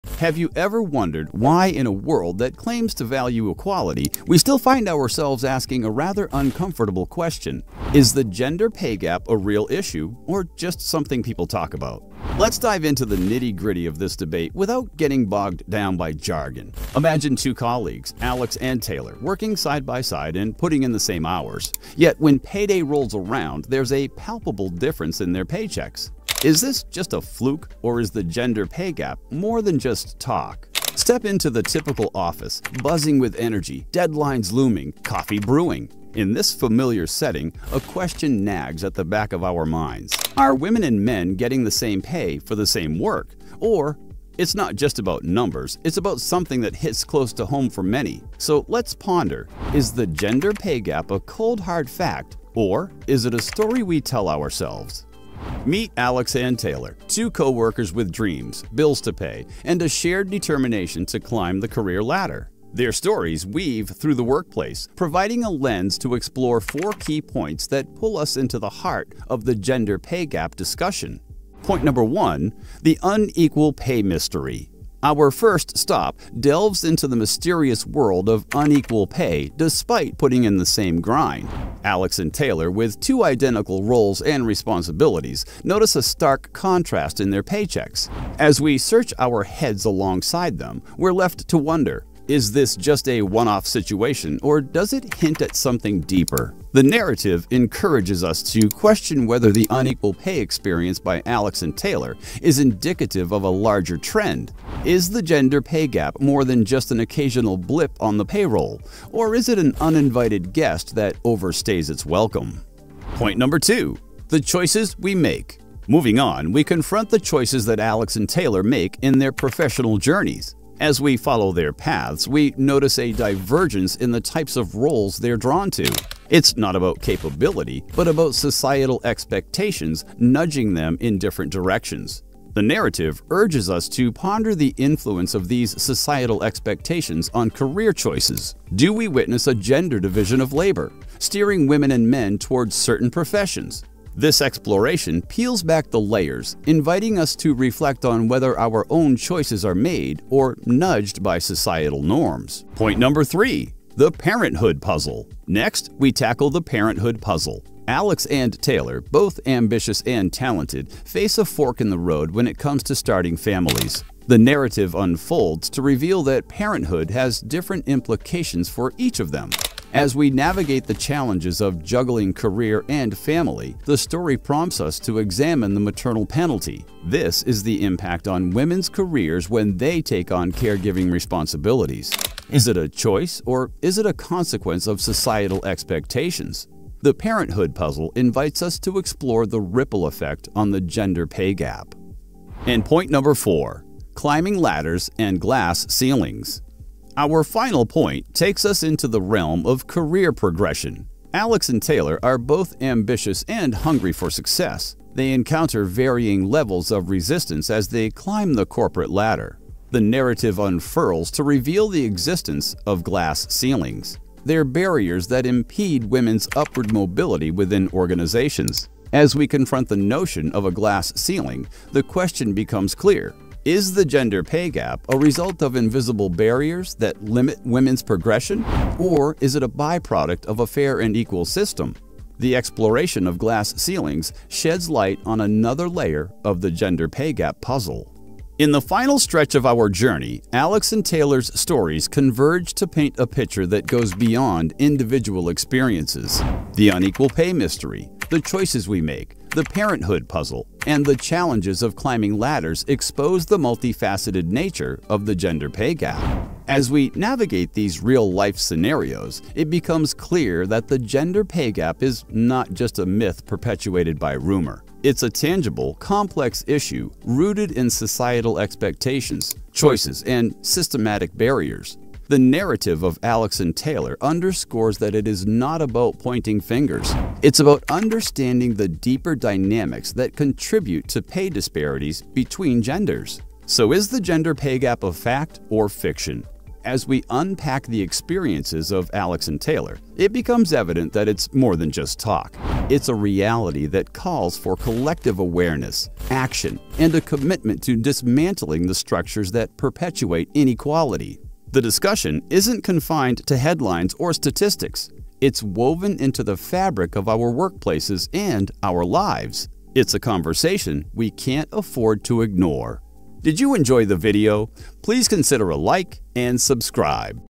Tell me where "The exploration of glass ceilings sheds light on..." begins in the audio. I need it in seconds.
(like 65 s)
232 s.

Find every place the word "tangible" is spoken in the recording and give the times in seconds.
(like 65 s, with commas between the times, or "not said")
265 s.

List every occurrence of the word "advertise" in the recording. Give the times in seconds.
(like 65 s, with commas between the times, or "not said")
not said.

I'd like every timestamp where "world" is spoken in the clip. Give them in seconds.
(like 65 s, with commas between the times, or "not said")
1 s, 77 s.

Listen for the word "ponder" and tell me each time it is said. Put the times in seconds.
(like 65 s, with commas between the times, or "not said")
48 s, 134 s.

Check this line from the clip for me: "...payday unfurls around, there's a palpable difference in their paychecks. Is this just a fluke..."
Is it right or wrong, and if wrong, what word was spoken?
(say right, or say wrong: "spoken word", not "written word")
wrong: "rolls", not "unfurls".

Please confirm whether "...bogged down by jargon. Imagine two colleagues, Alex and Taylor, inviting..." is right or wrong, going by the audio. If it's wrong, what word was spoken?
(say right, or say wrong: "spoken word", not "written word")
wrong: "working", not "inviting".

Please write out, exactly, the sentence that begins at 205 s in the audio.
They encounter varying levels of resistance as they climb the corporate ladder.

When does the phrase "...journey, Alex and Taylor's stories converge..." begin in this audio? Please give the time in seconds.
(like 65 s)
239 s.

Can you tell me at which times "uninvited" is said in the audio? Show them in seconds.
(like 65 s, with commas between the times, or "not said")
109 s.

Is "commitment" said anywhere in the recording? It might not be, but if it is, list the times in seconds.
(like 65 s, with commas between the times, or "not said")
297 s.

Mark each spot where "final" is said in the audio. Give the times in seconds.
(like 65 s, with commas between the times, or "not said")
197 s, 238 s.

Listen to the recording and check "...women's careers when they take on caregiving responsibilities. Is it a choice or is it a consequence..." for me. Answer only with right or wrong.
right.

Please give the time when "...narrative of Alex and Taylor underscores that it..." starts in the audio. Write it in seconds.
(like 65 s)
272 s.